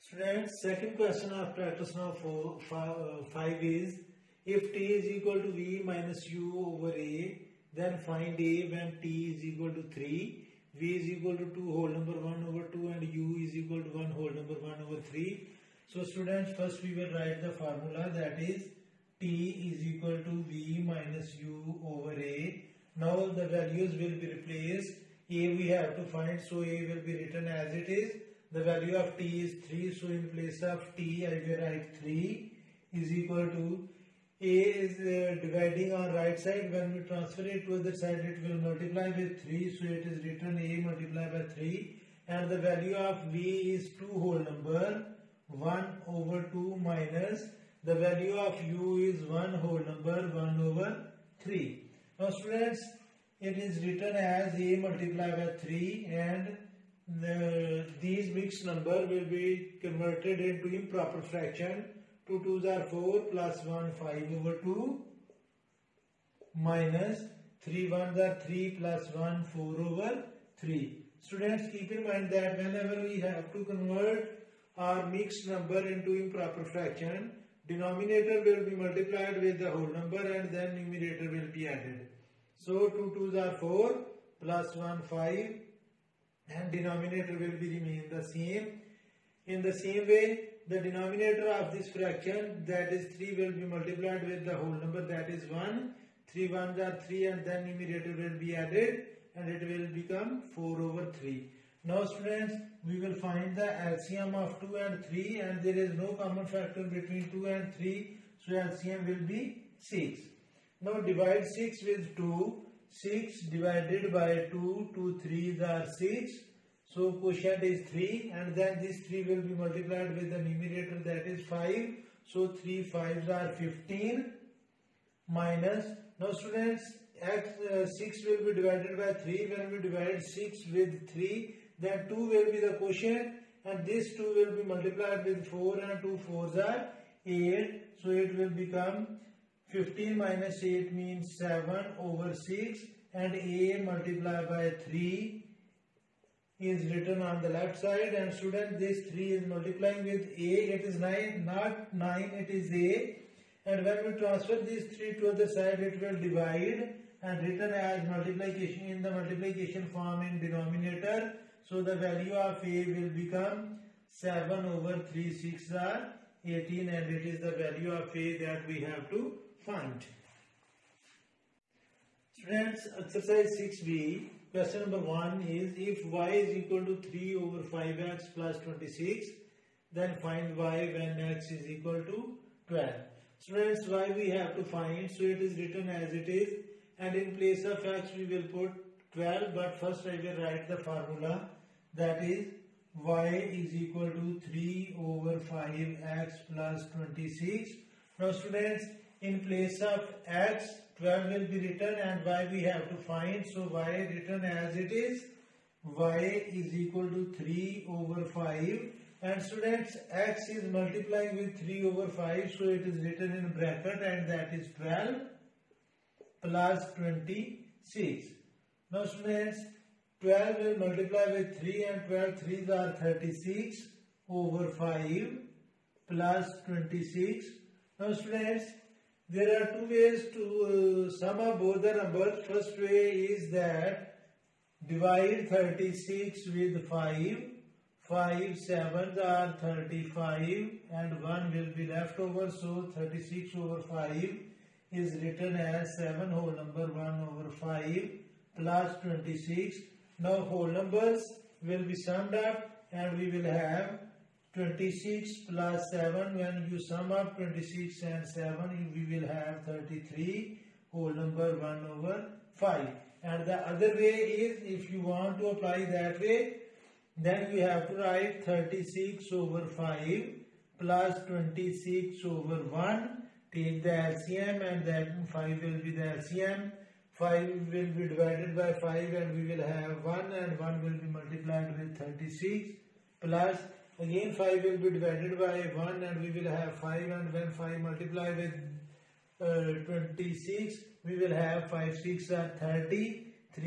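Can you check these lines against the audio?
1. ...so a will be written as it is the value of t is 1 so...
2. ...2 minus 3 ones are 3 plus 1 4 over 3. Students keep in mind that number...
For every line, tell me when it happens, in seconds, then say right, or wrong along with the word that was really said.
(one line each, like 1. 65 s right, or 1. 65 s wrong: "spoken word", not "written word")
1. 26 s wrong: "3", not "1"
2. 64 s wrong: "whenever", not "number".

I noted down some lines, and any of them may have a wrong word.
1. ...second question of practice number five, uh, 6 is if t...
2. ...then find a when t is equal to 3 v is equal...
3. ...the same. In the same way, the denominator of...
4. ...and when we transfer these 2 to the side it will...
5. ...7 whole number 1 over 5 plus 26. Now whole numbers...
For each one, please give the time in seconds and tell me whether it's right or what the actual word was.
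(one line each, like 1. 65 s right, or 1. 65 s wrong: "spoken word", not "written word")
1. 0 s wrong: "5", not "6"
2. 7 s right
3. 88 s right
4. 153 s wrong: "3", not "2"
5. 245 s right.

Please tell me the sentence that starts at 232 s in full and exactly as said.
First way is that divide 36 with 5.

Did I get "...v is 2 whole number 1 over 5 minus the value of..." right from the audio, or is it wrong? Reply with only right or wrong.
wrong.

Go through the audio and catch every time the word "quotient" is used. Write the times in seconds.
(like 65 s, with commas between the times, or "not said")
117 s, 132 s.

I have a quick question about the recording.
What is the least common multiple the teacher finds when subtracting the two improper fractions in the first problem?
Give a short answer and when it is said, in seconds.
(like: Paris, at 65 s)
6, at 108 s.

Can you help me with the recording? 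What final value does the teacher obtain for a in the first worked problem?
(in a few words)
7/18.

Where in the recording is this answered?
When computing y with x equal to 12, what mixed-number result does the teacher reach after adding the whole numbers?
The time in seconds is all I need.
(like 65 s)
259 s.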